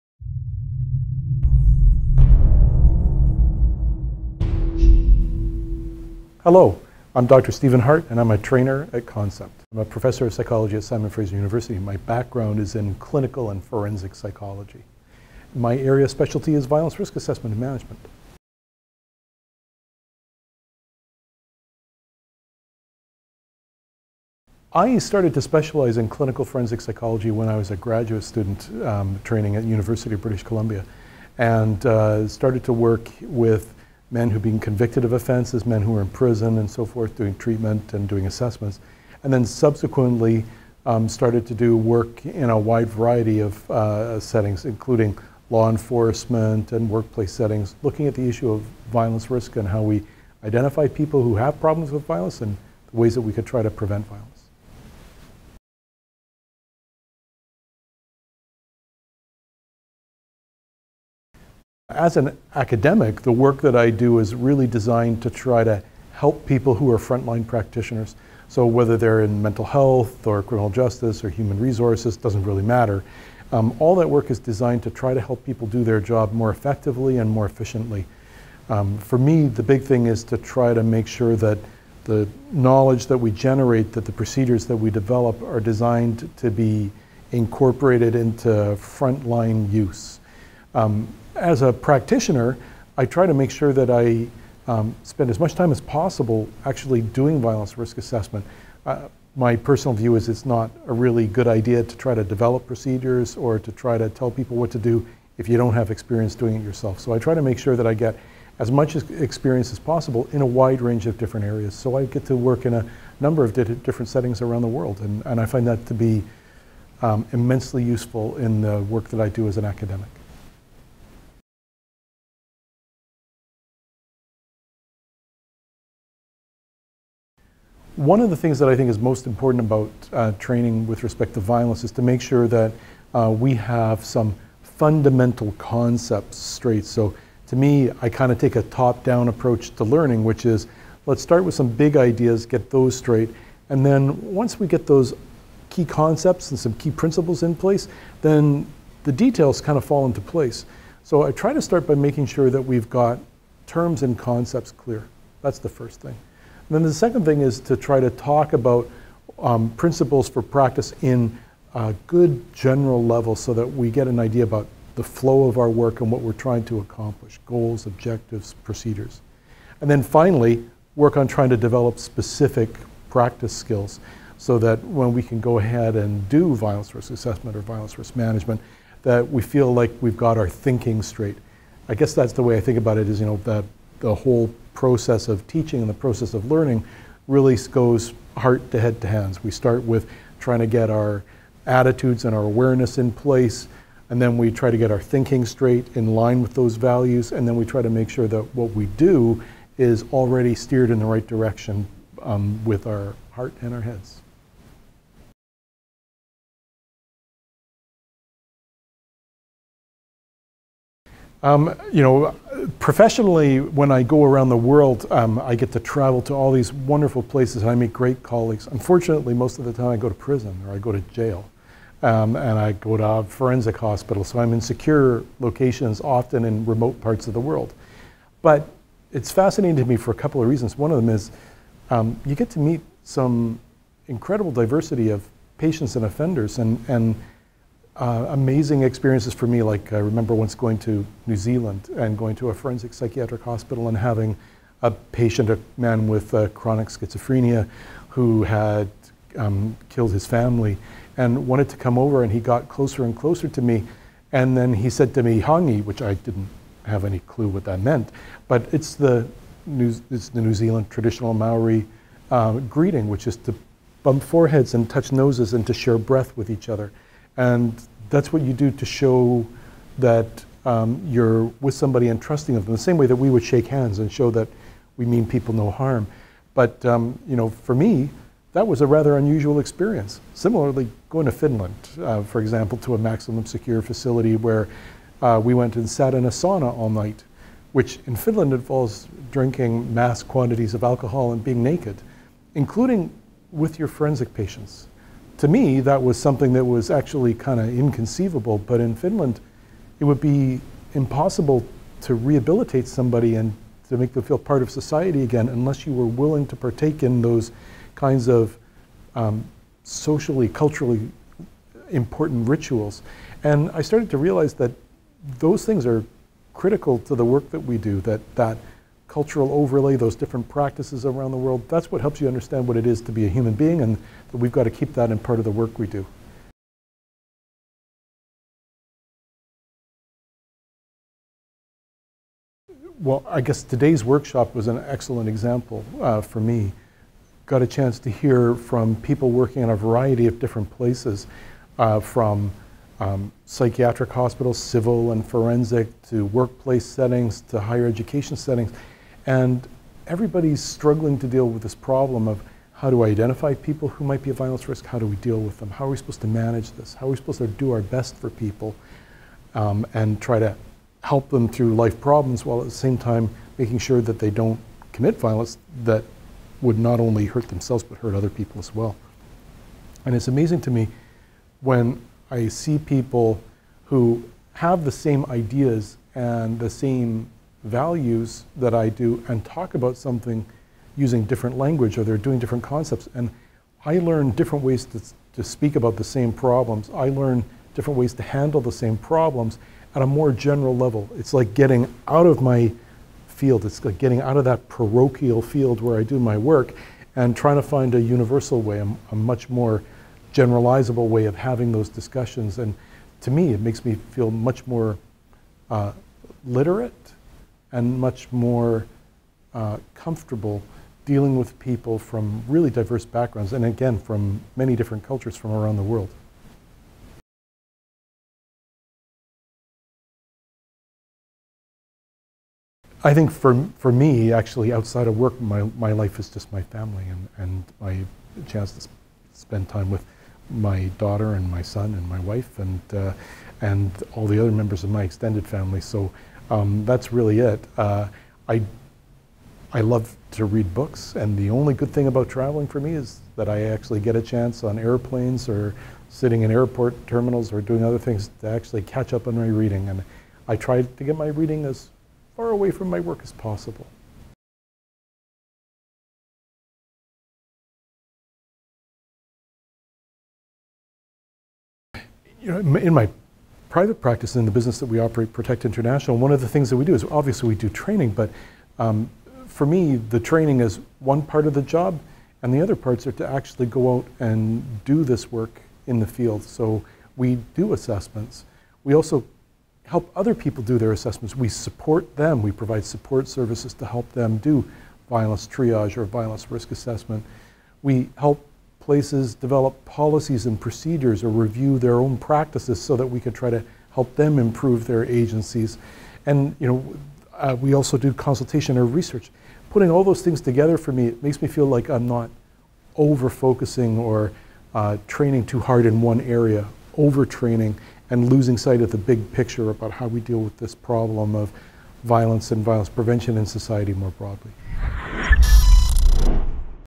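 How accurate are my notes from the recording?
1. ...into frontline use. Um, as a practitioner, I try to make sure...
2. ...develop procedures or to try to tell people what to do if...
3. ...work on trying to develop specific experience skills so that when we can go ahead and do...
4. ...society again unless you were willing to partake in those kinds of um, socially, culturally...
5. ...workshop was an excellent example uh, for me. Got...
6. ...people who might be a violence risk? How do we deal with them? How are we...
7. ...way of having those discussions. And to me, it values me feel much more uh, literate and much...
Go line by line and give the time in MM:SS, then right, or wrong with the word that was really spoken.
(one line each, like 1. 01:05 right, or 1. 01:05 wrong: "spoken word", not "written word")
1. 01:28 right
2. 01:42 right
3. 02:50 wrong: "practice", not "experience"
4. 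05:04 right
5. 05:34 right
6. 05:53 right
7. 06:41 wrong: "makes", not "values".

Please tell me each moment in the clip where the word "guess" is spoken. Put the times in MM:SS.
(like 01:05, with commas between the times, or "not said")
03:01, 05:33.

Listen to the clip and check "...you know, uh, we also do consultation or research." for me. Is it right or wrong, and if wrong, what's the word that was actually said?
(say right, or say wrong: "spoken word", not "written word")
right.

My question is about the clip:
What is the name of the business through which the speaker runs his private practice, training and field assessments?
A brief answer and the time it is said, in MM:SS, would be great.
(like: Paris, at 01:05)
Protect International, at 07:45.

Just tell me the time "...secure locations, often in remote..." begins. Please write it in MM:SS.
03:44.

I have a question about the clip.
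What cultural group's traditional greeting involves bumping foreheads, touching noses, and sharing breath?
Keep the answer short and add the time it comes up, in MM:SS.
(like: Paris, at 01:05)
Maori, at 04:21.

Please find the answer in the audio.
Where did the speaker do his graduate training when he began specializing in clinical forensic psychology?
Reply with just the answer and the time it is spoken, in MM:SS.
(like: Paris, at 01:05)
University of British Columbia, at 00:29.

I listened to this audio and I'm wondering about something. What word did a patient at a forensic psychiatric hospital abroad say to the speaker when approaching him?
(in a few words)
Hongi.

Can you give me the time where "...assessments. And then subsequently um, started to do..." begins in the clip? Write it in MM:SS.
00:38.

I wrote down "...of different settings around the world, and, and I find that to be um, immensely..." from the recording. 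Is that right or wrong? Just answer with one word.
right.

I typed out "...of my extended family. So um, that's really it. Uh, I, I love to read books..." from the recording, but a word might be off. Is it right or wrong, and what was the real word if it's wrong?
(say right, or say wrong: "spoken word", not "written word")
right.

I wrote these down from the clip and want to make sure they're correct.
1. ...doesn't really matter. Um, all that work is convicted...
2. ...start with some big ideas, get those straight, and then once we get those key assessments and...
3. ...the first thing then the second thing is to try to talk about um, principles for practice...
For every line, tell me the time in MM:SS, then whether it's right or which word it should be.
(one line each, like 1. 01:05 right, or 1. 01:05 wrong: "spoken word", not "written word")
1. 01:12 wrong: "designed", not "convicted"
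2. 02:21 wrong: "concepts", not "assessments"
3. 02:35 right.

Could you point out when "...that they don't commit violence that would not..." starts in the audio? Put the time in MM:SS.
06:04.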